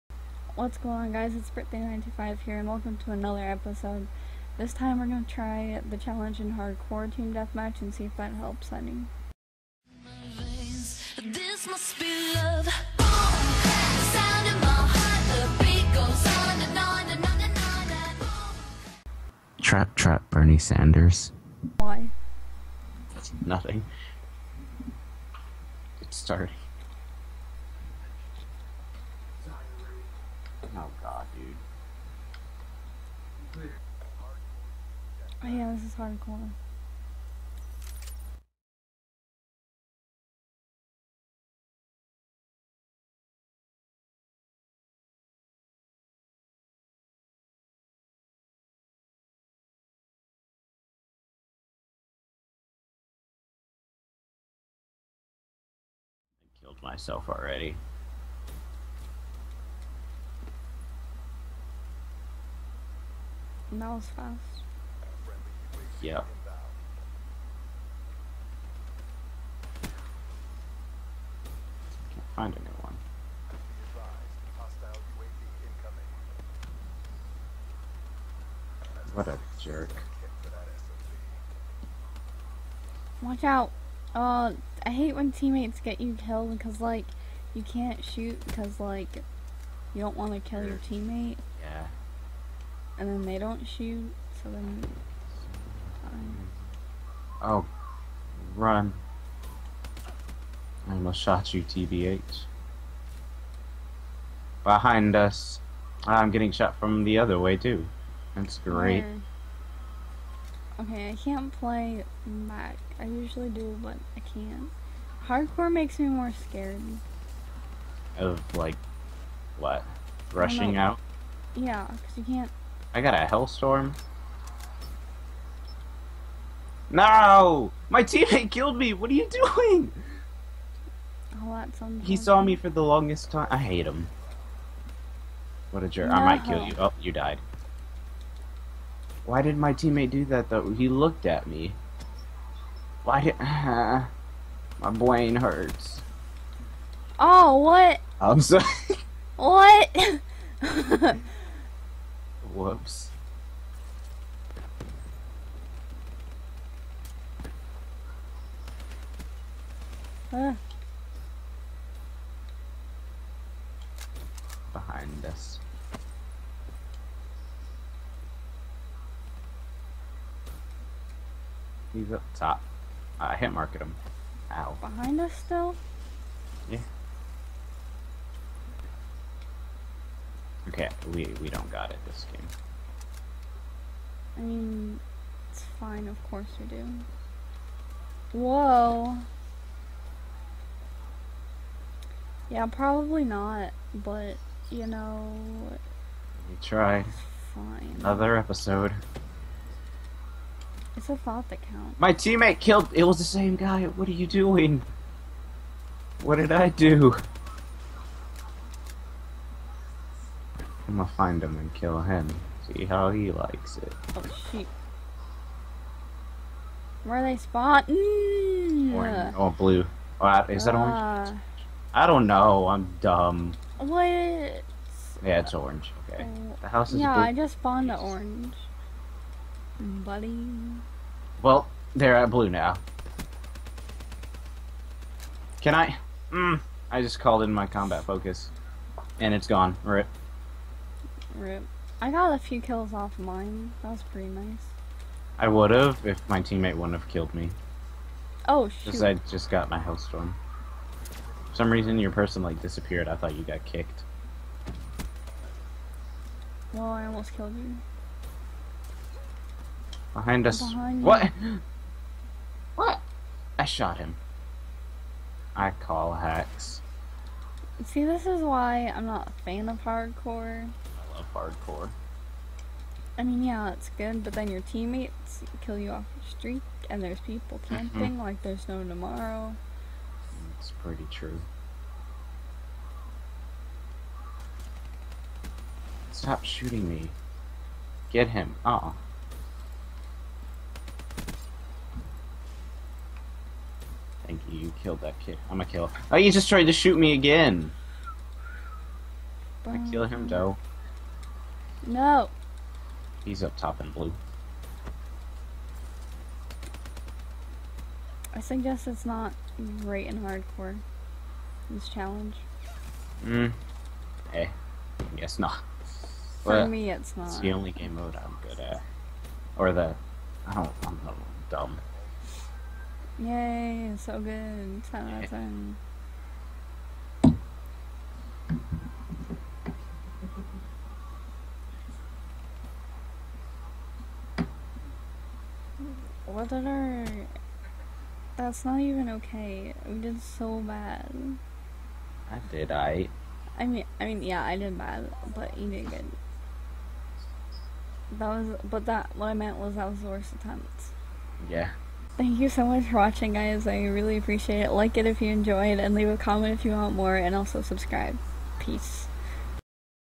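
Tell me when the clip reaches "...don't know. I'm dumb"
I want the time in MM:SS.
03:42.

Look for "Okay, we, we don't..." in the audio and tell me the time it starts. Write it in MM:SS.
03:00.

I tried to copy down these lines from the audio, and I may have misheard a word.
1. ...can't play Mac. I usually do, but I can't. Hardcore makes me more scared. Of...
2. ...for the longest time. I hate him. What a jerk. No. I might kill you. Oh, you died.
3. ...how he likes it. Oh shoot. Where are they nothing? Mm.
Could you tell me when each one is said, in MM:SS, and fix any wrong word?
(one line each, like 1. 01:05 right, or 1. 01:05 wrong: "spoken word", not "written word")
1. 01:51 right
2. 02:12 right
3. 03:32 wrong: "spawning", not "nothing".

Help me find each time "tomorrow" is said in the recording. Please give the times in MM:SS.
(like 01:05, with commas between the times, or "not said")
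04:38.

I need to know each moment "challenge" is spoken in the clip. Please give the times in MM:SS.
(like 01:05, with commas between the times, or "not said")
00:05, 05:11.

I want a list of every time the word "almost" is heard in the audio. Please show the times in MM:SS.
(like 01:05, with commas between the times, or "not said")
01:40, 04:17.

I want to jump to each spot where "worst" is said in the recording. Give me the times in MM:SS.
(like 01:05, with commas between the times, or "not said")
05:50.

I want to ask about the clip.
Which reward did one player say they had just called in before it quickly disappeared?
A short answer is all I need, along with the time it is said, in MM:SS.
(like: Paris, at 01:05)
combat focus, at 03:57.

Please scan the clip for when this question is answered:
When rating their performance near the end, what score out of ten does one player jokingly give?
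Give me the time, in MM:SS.
05:24.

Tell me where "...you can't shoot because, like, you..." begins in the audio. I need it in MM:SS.
01:27.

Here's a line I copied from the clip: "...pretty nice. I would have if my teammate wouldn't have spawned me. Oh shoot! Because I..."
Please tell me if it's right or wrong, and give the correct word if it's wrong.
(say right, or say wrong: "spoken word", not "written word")
wrong: "killed", not "spawned".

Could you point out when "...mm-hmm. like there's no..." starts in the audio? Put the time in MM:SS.
04:38.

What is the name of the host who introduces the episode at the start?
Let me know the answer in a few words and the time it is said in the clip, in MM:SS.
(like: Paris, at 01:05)
Britney925, at 00:01.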